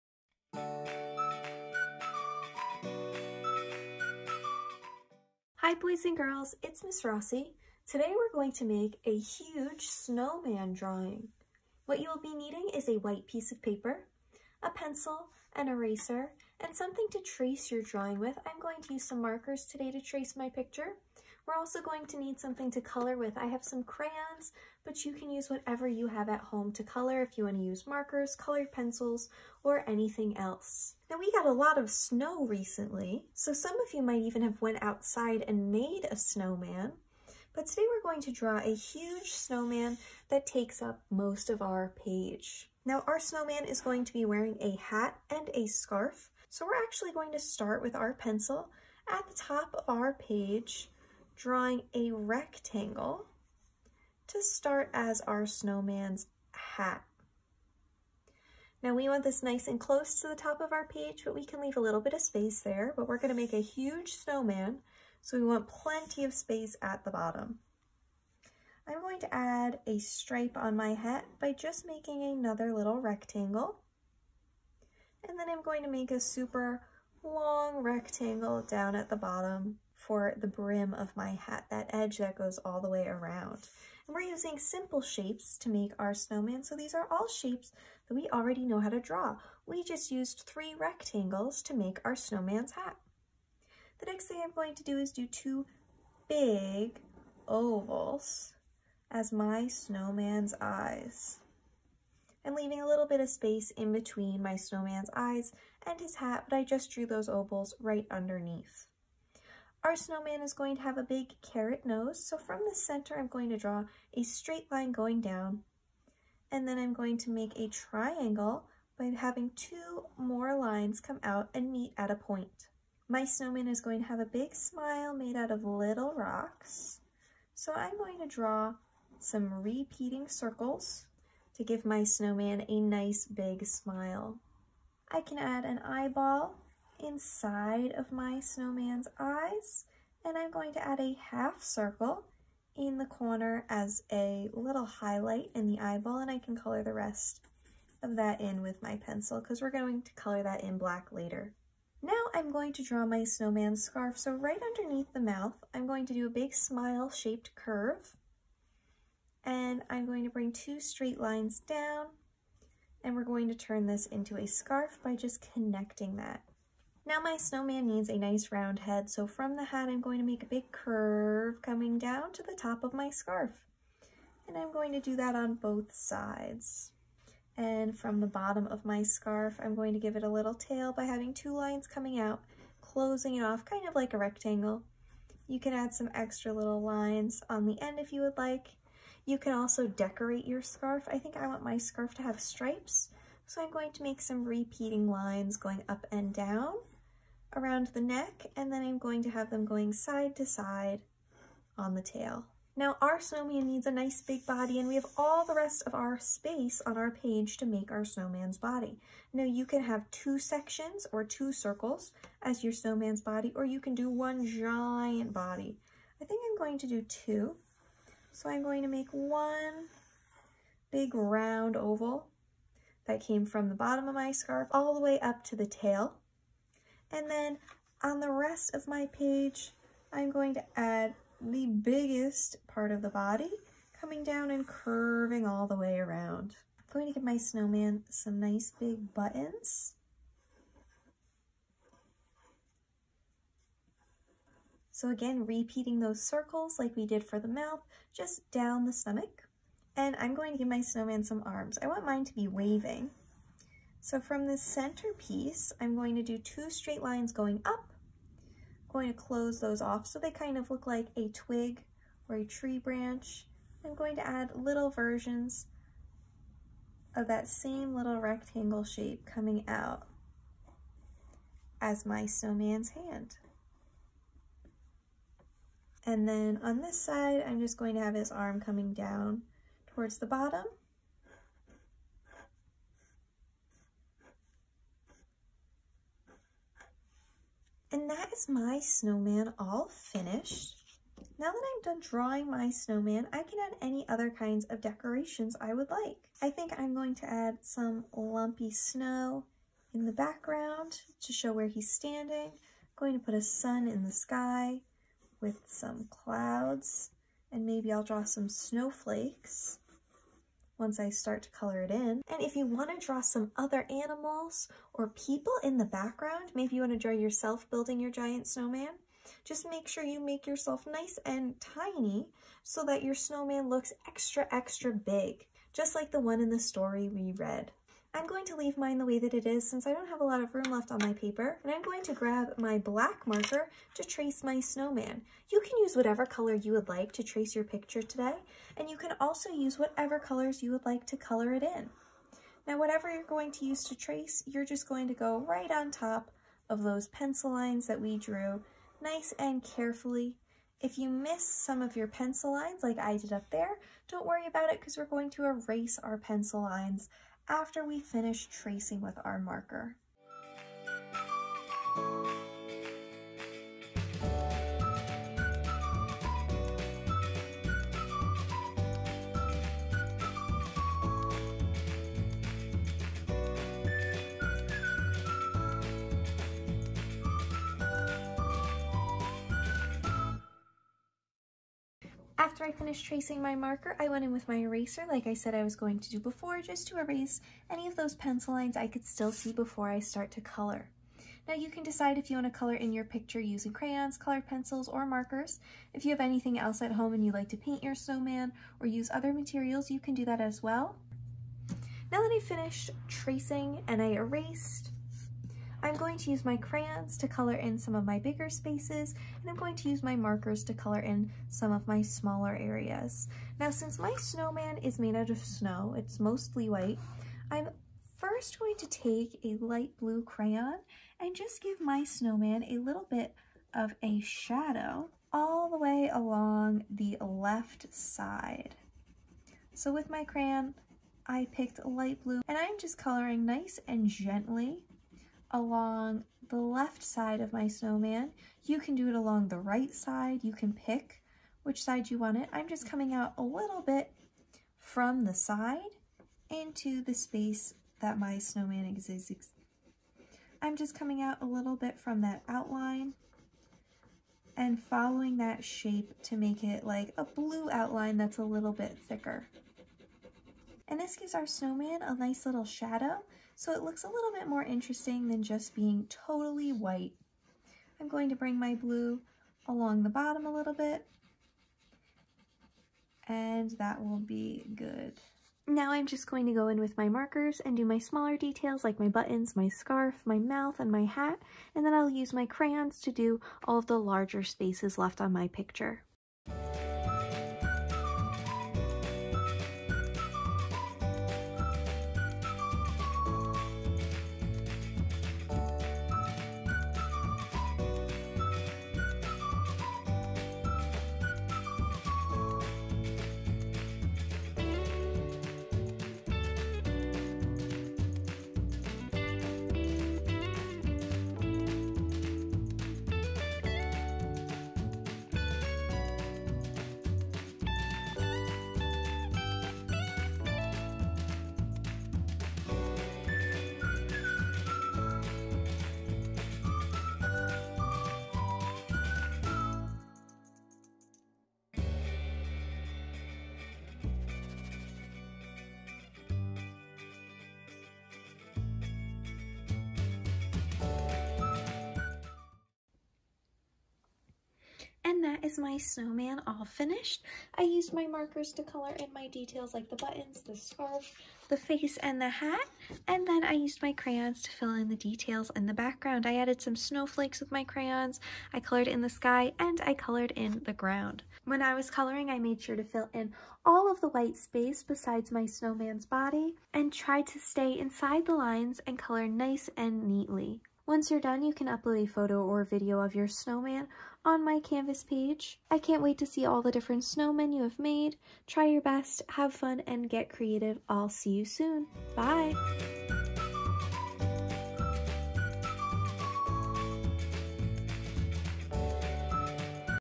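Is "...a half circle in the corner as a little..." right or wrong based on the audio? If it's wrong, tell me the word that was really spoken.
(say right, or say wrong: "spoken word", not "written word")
right.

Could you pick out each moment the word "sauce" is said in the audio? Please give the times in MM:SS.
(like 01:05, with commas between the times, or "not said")
not said.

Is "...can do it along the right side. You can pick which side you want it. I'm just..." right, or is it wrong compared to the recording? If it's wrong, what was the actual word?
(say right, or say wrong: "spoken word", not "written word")
right.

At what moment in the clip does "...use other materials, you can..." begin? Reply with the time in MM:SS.
06:38.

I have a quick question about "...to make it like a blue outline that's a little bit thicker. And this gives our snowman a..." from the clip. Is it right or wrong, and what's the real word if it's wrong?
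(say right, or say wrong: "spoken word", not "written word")
right.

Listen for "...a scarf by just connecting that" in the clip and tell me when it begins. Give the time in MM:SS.
02:44.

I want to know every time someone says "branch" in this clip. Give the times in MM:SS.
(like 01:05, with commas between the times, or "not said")
04:22.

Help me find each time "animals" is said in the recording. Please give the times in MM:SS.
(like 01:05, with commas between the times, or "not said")
05:13.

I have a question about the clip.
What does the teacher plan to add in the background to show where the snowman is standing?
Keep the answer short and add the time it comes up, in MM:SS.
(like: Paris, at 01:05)
lumpy snow, at 04:58.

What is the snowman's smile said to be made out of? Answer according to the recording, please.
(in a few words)
little rocks.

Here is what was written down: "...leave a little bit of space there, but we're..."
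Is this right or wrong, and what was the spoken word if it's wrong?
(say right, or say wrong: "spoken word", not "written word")
right.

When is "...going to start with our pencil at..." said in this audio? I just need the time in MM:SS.
00:47.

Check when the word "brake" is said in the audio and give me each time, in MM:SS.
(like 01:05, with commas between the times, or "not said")
not said.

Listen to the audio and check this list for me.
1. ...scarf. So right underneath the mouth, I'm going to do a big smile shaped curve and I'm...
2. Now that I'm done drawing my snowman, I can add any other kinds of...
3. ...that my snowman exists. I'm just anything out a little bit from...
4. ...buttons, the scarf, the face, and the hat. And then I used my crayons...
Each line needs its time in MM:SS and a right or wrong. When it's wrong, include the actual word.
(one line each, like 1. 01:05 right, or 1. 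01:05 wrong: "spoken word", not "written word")
1. 02:33 right
2. 04:51 right
3. 07:27 wrong: "coming", not "anything"
4. 09:09 right.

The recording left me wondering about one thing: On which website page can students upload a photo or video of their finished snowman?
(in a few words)
Canvas.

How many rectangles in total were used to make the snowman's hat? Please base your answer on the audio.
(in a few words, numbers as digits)
3.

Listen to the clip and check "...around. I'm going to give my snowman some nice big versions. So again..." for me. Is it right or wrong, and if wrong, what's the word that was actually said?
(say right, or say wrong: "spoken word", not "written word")
wrong: "buttons", not "versions".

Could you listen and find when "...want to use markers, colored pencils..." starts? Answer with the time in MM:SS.
00:27.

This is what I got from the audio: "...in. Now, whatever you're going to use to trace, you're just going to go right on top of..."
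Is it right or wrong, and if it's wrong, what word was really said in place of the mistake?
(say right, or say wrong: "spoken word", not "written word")
right.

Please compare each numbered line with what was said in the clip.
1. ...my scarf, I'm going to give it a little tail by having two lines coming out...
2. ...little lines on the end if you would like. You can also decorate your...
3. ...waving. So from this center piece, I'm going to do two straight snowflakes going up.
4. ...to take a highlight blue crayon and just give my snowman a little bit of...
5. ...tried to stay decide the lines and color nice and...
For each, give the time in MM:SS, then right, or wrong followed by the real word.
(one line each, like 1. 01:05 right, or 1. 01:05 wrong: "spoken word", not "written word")
1. 02:58 right
2. 03:06 right
3. 04:12 wrong: "lines", not "snowflakes"
4. 06:58 wrong: "light", not "highlight"
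5. 09:26 wrong: "inside", not "decide".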